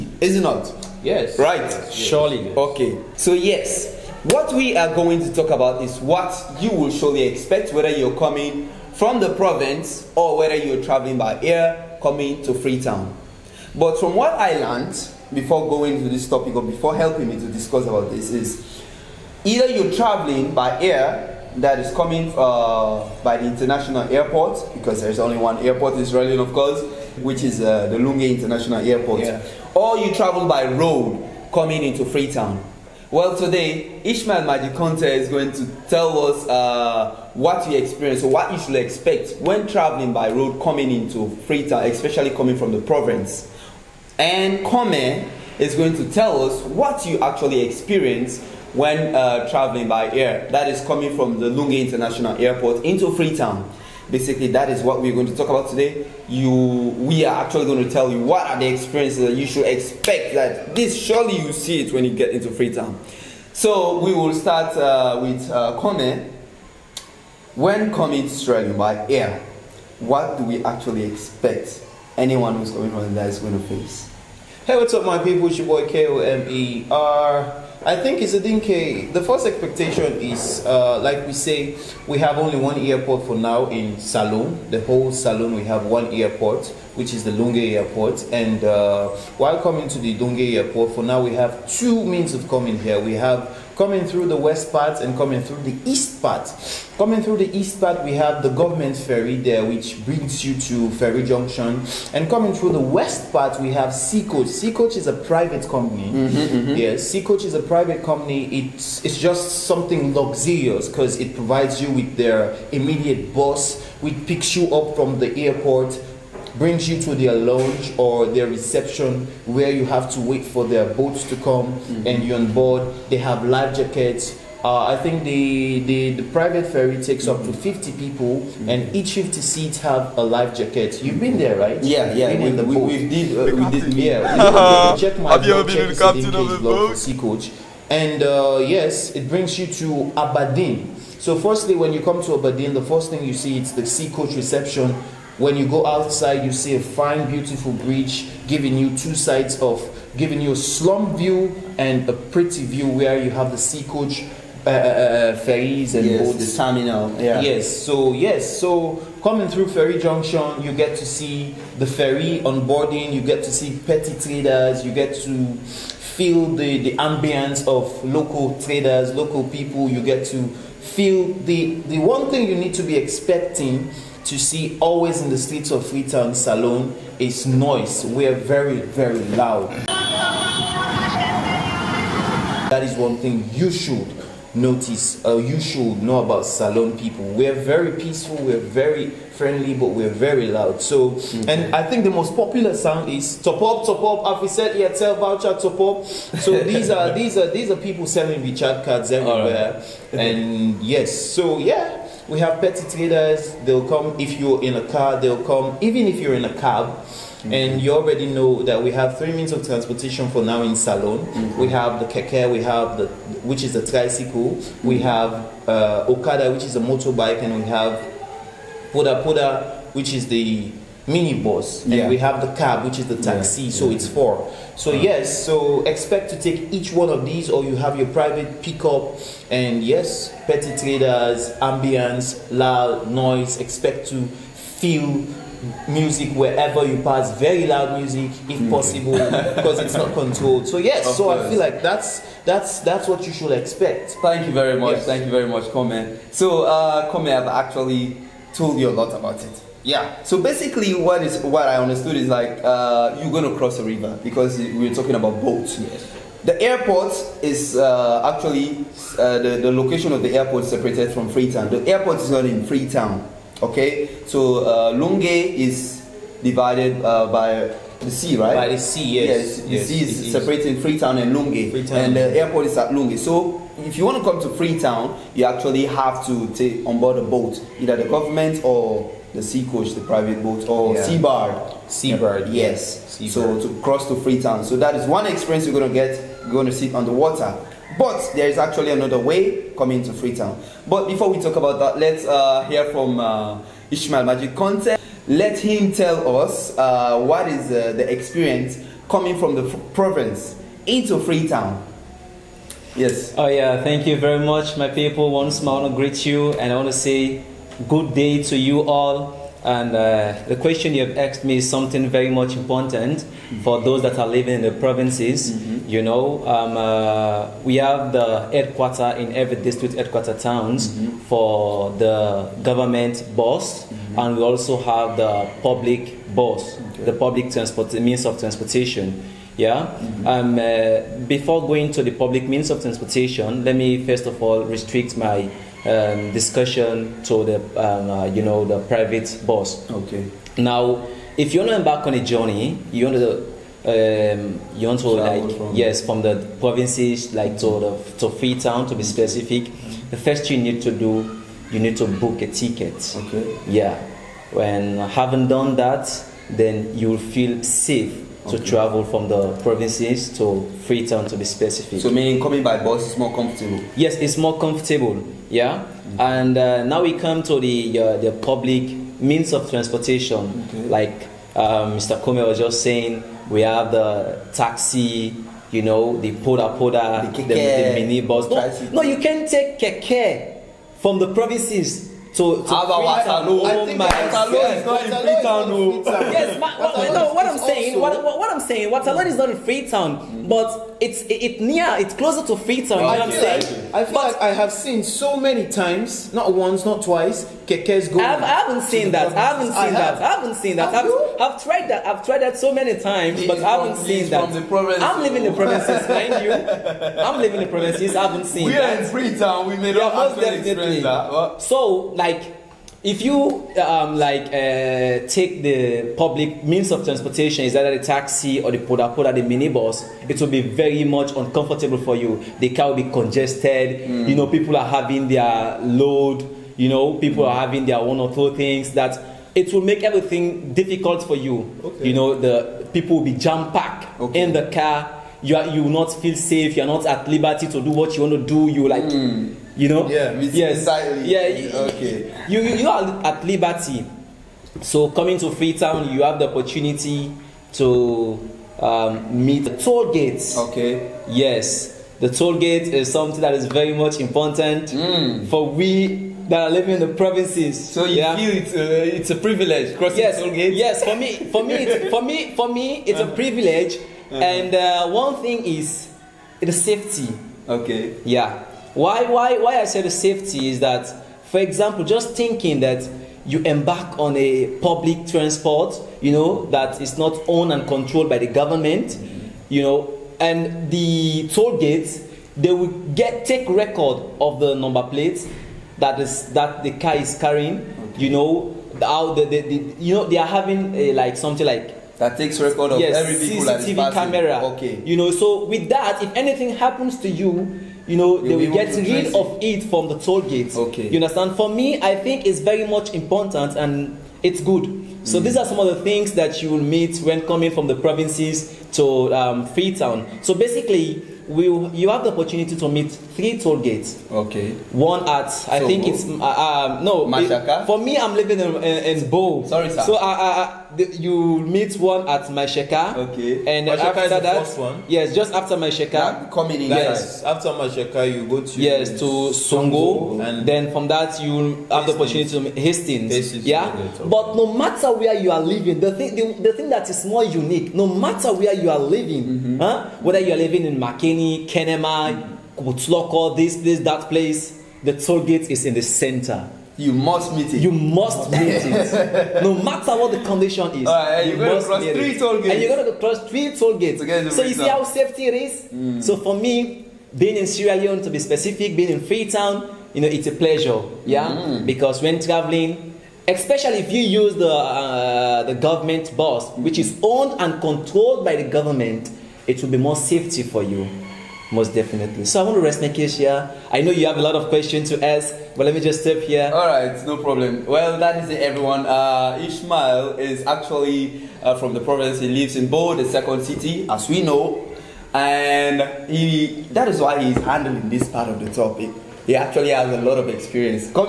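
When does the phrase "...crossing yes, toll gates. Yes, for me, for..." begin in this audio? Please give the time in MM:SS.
07:39.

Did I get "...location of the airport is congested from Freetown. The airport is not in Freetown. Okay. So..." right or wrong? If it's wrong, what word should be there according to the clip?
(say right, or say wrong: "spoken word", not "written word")
wrong: "separated", not "congested".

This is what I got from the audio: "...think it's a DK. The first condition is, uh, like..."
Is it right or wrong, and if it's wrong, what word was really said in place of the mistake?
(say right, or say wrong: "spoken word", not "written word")
wrong: "expectation", not "condition".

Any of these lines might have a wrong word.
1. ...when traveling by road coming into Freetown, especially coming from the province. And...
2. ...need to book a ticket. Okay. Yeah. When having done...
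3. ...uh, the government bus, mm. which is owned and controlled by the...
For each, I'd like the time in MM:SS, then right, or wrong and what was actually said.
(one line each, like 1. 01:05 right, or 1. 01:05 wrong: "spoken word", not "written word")
1. 00:39 right
2. 05:51 right
3. 09:24 right.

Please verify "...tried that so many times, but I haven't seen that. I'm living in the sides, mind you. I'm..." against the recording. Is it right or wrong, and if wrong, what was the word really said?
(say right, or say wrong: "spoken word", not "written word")
wrong: "provinces", not "sides".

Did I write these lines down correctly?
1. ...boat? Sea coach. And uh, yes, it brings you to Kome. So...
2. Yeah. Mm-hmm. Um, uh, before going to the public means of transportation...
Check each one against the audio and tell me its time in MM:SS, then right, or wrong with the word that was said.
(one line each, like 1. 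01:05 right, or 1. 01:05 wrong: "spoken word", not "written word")
1. 02:16 wrong: "Aberdeen", not "Kome"
2. 05:29 right.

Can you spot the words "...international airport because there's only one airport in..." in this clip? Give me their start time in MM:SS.
00:23.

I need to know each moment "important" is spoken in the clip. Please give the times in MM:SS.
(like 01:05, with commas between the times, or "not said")
05:12, 07:34, 08:23.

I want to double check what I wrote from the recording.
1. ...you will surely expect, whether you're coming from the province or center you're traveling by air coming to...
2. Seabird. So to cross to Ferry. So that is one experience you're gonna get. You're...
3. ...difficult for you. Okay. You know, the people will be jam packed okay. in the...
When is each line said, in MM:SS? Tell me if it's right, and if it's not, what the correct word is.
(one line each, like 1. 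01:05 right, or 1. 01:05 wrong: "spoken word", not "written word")
1. 00:06 wrong: "whether", not "center"
2. 04:43 wrong: "Freetown", not "Ferry"
3. 07:10 right.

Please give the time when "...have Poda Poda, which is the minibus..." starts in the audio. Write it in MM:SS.
03:37.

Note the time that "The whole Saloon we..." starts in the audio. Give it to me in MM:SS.
01:24.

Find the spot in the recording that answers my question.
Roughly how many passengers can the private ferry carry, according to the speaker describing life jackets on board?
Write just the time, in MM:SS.
02:07.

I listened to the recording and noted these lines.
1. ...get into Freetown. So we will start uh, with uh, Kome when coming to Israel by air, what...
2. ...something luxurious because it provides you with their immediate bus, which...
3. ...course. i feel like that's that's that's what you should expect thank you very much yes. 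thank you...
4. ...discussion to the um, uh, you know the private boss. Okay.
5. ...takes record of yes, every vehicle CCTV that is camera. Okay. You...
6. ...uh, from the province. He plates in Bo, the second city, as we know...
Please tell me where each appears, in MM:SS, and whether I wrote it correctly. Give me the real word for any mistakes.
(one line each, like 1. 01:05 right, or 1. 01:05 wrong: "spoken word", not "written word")
1. 01:02 right
2. 01:49 right
3. 04:01 right
4. 05:36 right
5. 08:12 right
6. 09:41 wrong: "lives", not "plates".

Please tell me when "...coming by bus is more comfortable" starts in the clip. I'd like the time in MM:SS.
06:02.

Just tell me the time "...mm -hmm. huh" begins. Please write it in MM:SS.
08:59.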